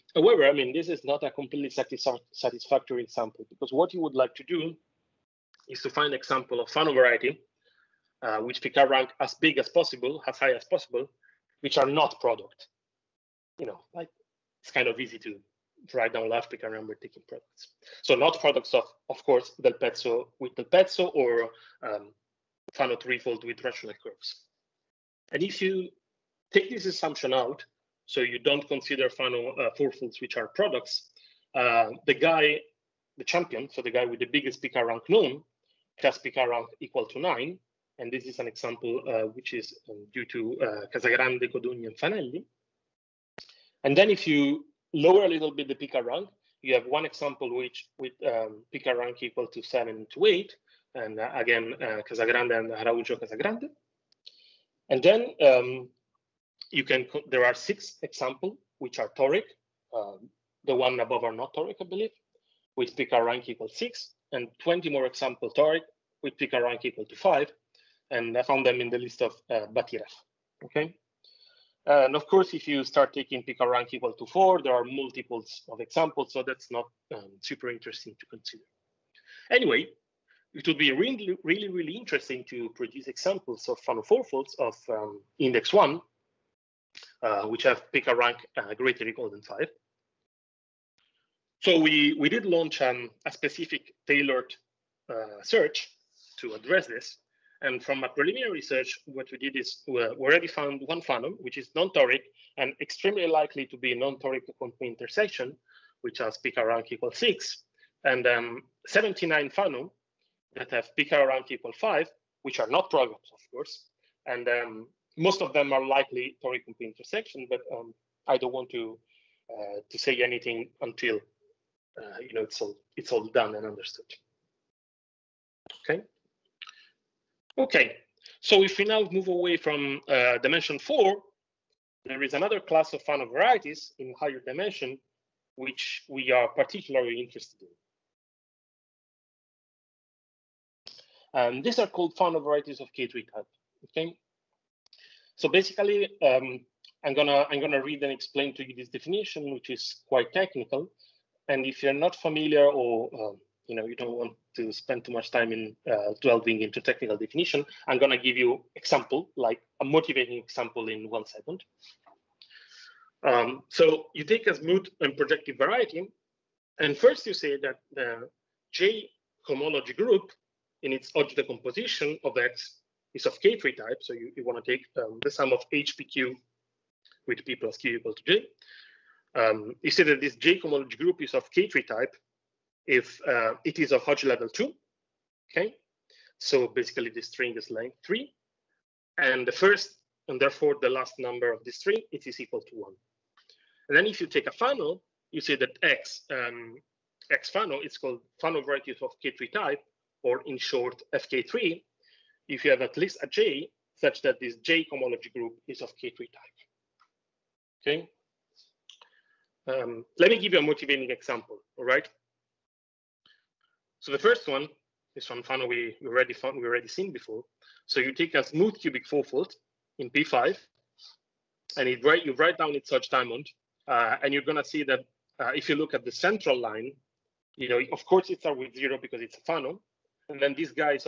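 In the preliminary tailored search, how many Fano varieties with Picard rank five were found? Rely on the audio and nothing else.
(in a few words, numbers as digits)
79.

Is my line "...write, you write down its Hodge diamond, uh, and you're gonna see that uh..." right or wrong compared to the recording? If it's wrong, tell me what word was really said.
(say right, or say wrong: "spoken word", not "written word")
right.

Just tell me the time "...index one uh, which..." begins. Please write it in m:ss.
1:25.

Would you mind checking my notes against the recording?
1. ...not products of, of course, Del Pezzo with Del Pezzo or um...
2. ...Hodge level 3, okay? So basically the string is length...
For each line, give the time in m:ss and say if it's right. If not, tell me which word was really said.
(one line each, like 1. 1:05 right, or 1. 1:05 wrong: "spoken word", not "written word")
1. 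0:18 right
2. 3:04 wrong: "2", not "3".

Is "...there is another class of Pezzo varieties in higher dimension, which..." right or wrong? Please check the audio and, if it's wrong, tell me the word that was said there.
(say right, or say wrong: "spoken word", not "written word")
wrong: "Fano", not "Pezzo".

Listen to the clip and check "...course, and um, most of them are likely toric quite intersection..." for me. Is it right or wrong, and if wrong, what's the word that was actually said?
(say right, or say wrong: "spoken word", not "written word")
wrong: "complete", not "quite".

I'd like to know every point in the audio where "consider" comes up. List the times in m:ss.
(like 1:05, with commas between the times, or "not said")
0:28, 1:18.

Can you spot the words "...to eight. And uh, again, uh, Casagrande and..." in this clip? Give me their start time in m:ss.
0:50.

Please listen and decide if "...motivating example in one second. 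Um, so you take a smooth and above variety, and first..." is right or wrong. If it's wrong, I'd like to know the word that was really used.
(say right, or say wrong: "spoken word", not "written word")
wrong: "projective", not "above".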